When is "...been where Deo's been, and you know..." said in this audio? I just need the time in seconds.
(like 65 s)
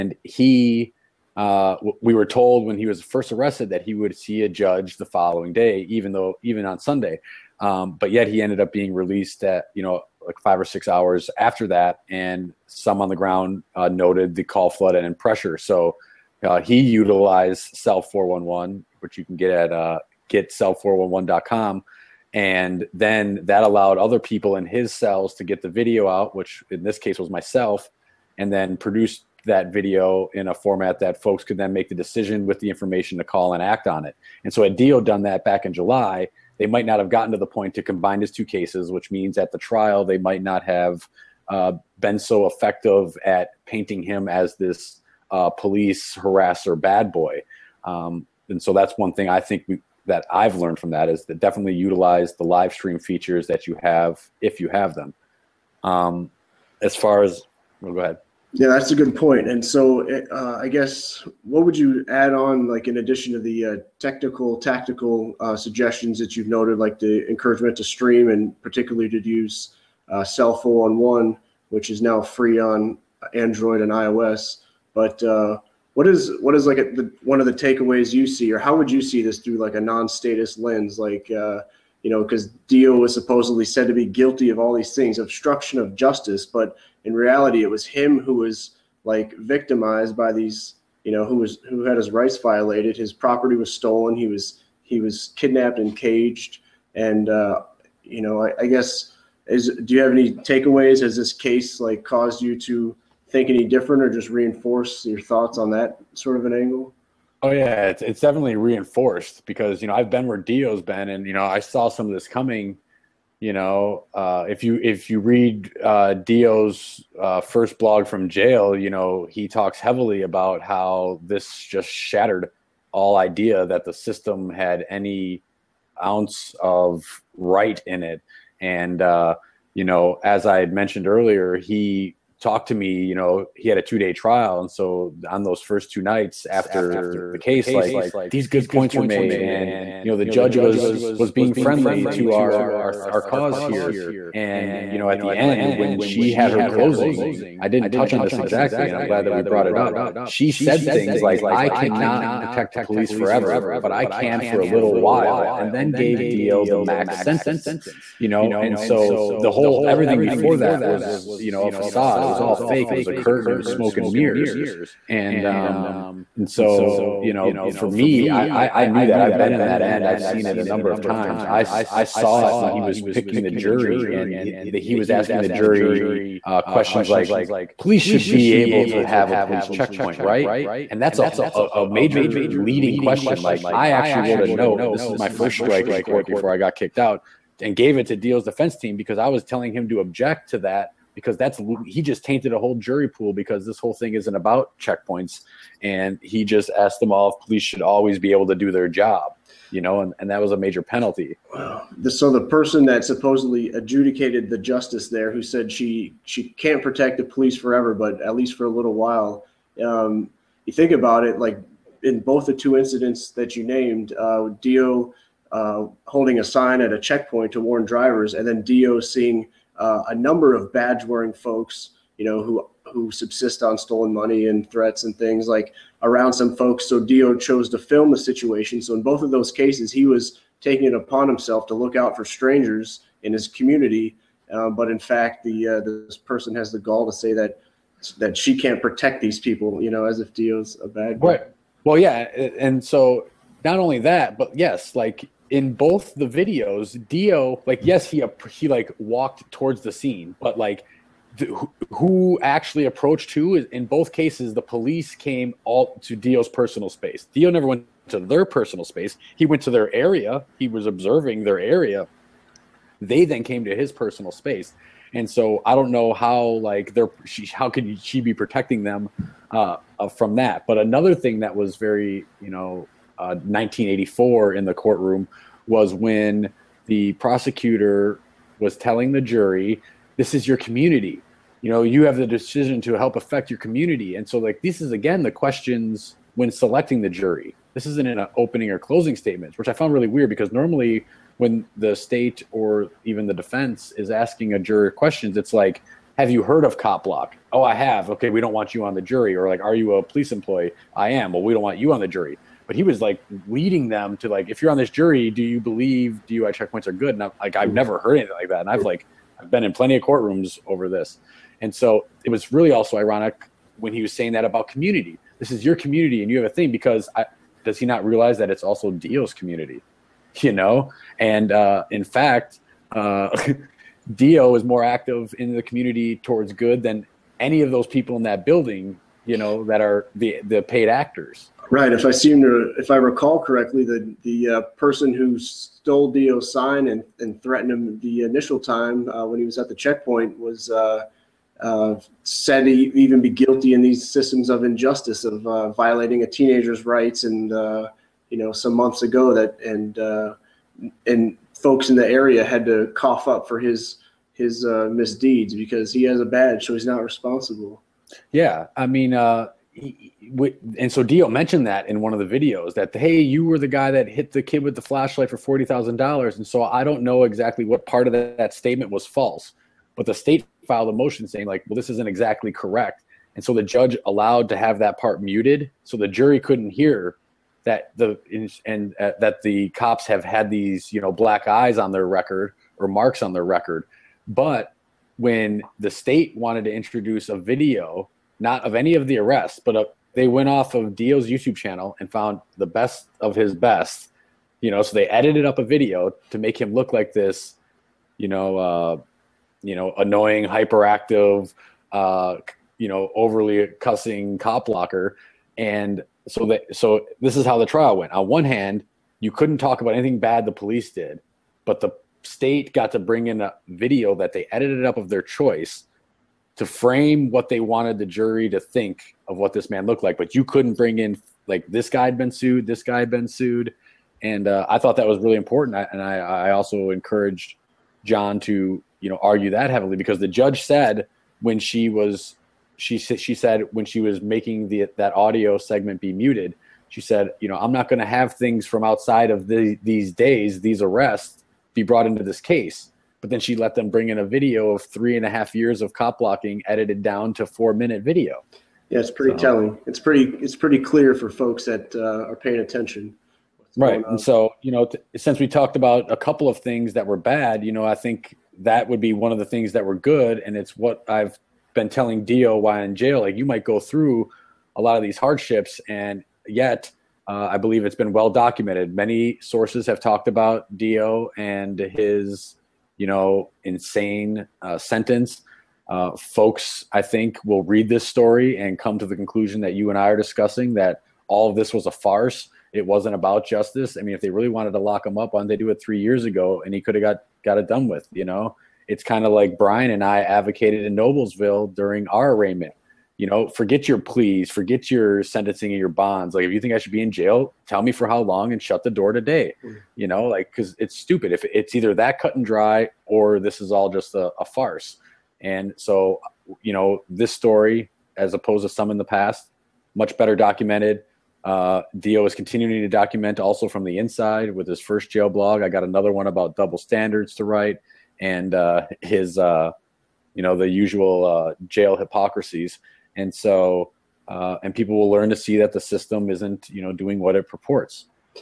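110 s.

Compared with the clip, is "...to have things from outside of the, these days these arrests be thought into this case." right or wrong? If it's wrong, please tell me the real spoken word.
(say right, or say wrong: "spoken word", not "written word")
wrong: "brought", not "thought".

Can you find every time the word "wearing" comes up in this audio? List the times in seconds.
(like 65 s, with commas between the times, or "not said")
221 s.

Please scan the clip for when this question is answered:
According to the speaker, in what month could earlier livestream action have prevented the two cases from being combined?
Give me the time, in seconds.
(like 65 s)
35 s.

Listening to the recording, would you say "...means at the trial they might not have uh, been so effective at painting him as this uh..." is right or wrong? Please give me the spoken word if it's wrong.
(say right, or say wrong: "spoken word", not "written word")
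right.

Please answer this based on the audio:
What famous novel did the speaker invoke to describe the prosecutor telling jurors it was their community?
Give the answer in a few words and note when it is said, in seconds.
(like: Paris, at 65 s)
1984, at 273 s.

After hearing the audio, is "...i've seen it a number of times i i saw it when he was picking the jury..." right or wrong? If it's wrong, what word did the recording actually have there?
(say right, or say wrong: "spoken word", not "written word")
right.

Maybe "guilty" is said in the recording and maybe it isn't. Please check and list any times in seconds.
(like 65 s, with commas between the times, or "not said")
84 s, 343 s.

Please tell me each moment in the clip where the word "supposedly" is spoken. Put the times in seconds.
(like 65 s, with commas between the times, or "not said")
83 s, 203 s.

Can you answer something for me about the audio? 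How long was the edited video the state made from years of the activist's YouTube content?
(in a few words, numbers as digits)
4 minutes.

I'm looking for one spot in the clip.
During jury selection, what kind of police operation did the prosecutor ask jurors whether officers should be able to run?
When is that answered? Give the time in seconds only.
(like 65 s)
179 s.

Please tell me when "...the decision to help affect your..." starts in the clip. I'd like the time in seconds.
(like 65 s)
282 s.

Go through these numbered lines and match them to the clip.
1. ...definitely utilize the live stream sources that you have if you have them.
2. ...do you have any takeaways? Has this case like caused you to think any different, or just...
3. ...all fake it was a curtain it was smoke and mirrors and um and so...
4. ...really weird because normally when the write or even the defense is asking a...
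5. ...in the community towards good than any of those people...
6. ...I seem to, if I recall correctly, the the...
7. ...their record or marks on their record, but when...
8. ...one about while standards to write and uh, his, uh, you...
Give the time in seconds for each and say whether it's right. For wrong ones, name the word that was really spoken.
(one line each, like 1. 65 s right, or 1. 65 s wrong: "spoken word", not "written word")
1. 51 s wrong: "features", not "sources"
2. 99 s right
3. 162 s right
4. 289 s wrong: "state", not "write"
5. 325 s right
6. 332 s right
7. 381 s right
8. 516 s wrong: "double", not "while".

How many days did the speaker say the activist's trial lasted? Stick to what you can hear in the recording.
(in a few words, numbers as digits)
2.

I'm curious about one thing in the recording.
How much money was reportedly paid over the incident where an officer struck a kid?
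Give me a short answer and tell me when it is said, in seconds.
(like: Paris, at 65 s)
$40,000, at 365 s.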